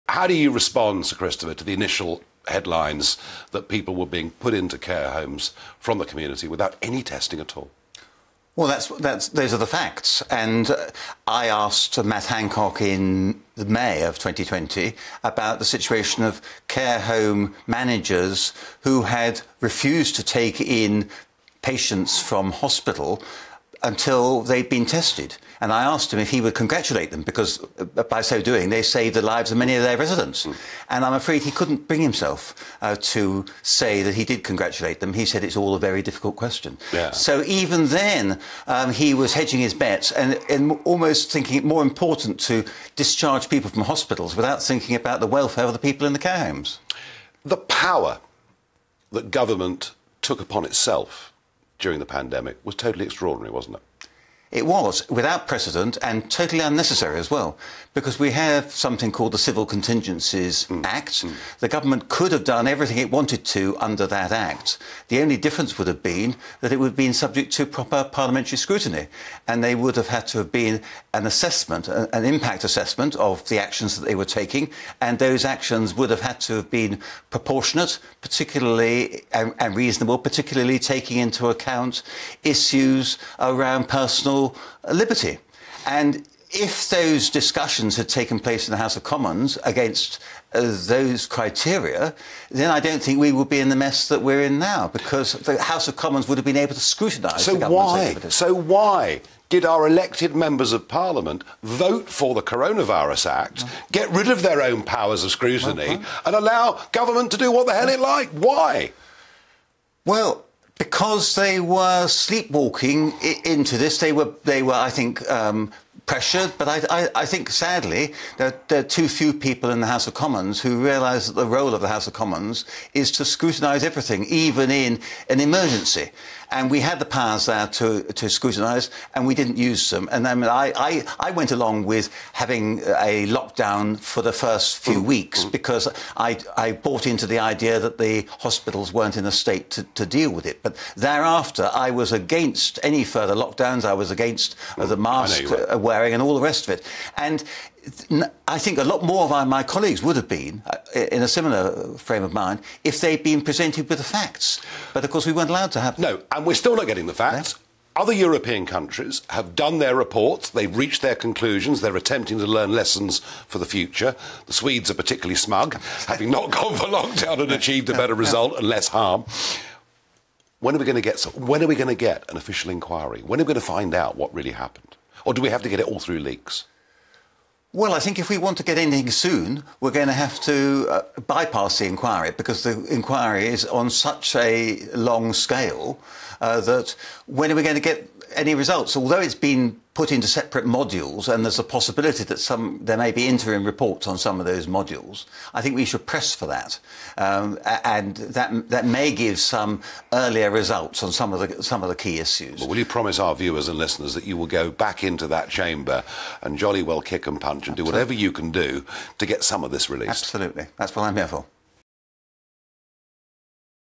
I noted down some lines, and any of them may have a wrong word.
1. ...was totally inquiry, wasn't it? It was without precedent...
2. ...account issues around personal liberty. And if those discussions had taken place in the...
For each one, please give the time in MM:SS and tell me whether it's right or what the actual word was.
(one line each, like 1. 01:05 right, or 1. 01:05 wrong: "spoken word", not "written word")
1. 00:52 wrong: "extraordinary", not "inquiry"
2. 01:21 right.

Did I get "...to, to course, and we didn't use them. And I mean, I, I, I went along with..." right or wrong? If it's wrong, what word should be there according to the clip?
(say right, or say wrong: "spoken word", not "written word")
wrong: "scrutinise", not "course".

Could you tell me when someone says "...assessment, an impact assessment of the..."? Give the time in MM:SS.
01:11.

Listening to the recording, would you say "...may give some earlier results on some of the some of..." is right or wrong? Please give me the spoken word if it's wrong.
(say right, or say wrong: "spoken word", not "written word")
right.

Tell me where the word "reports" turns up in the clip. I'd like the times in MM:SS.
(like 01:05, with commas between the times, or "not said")
02:39, 03:13.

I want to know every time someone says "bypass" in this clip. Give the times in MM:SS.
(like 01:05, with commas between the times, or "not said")
03:01.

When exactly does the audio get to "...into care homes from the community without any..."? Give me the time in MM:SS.
00:04.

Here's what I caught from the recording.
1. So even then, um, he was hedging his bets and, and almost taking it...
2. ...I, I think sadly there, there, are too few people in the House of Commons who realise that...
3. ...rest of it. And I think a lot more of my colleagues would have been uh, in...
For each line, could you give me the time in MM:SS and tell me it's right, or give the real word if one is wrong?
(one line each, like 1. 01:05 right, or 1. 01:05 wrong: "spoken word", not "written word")
1. 00:37 wrong: "thinking", not "taking"
2. 01:57 right
3. 02:26 right.